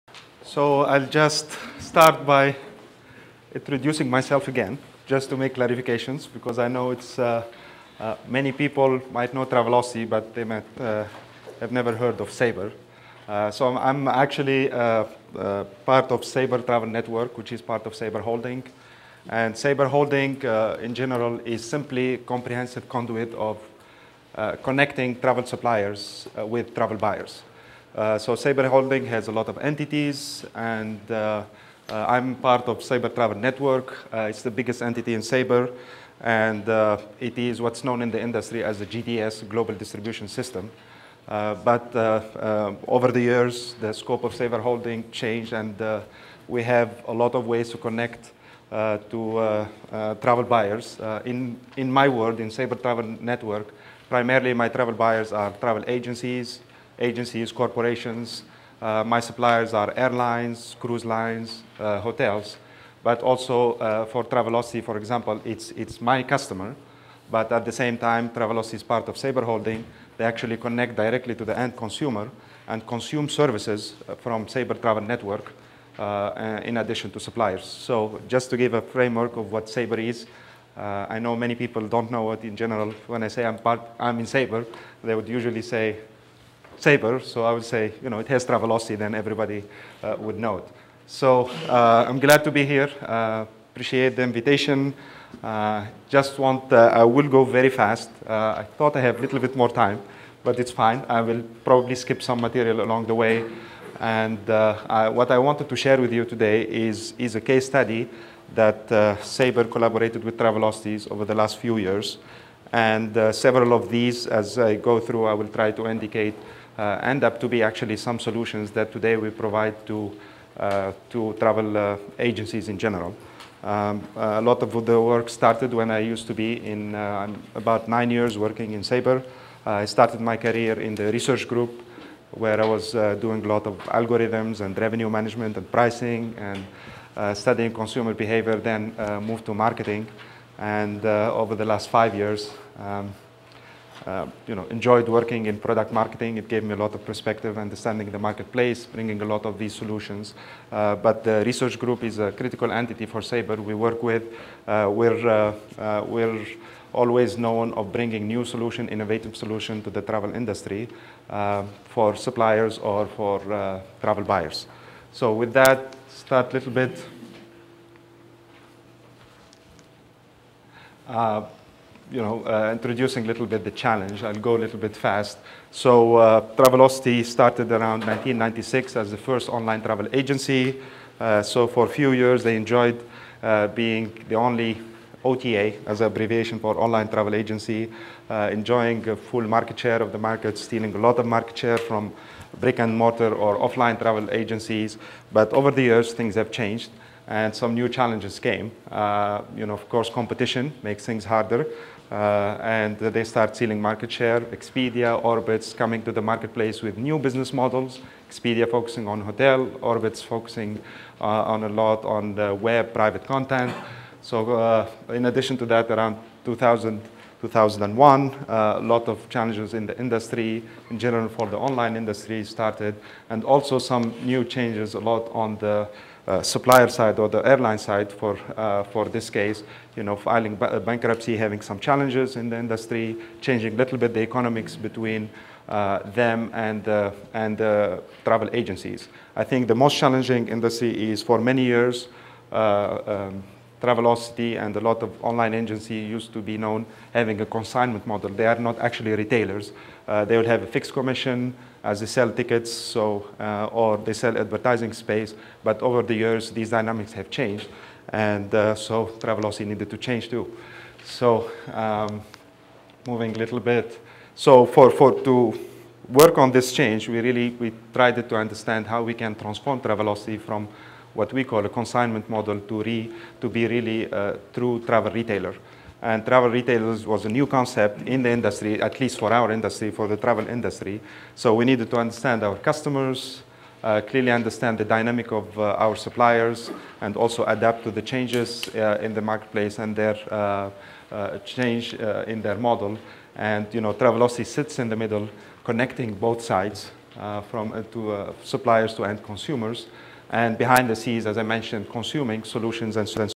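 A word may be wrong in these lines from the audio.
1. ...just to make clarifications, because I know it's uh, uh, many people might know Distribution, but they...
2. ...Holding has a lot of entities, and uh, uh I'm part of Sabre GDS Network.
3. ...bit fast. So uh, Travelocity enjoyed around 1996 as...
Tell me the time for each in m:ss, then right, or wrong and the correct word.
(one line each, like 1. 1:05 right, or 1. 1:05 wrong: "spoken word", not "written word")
1. 0:05 wrong: "Travelocity", not "Distribution"
2. 0:28 wrong: "Travel", not "GDS"
3. 2:54 wrong: "started", not "enjoyed".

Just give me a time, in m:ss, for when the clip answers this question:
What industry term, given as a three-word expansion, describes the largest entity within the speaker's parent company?
0:39.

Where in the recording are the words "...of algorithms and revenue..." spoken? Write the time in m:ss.
2:13.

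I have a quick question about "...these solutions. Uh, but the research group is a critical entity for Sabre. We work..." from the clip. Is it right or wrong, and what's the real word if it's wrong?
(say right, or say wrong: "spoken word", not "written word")
right.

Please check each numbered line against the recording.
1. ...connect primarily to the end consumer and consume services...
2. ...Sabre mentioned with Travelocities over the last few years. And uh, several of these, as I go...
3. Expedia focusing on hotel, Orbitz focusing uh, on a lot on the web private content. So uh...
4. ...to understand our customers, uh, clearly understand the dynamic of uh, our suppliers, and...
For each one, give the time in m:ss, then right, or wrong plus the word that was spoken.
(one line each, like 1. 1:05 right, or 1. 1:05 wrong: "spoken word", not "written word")
1. 1:10 wrong: "directly", not "primarily"
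2. 1:49 wrong: "collaborated", not "mentioned"
3. 3:28 right
4. 4:41 right.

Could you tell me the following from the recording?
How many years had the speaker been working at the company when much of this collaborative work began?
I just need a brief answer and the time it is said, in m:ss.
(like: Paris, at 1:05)
9, at 2:07.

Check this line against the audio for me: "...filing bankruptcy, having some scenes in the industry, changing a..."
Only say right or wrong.
wrong.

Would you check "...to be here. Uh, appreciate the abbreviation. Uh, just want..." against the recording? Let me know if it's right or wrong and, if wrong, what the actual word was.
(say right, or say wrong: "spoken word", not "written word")
wrong: "invitation", not "abbreviation".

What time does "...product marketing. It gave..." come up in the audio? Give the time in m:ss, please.
2:25.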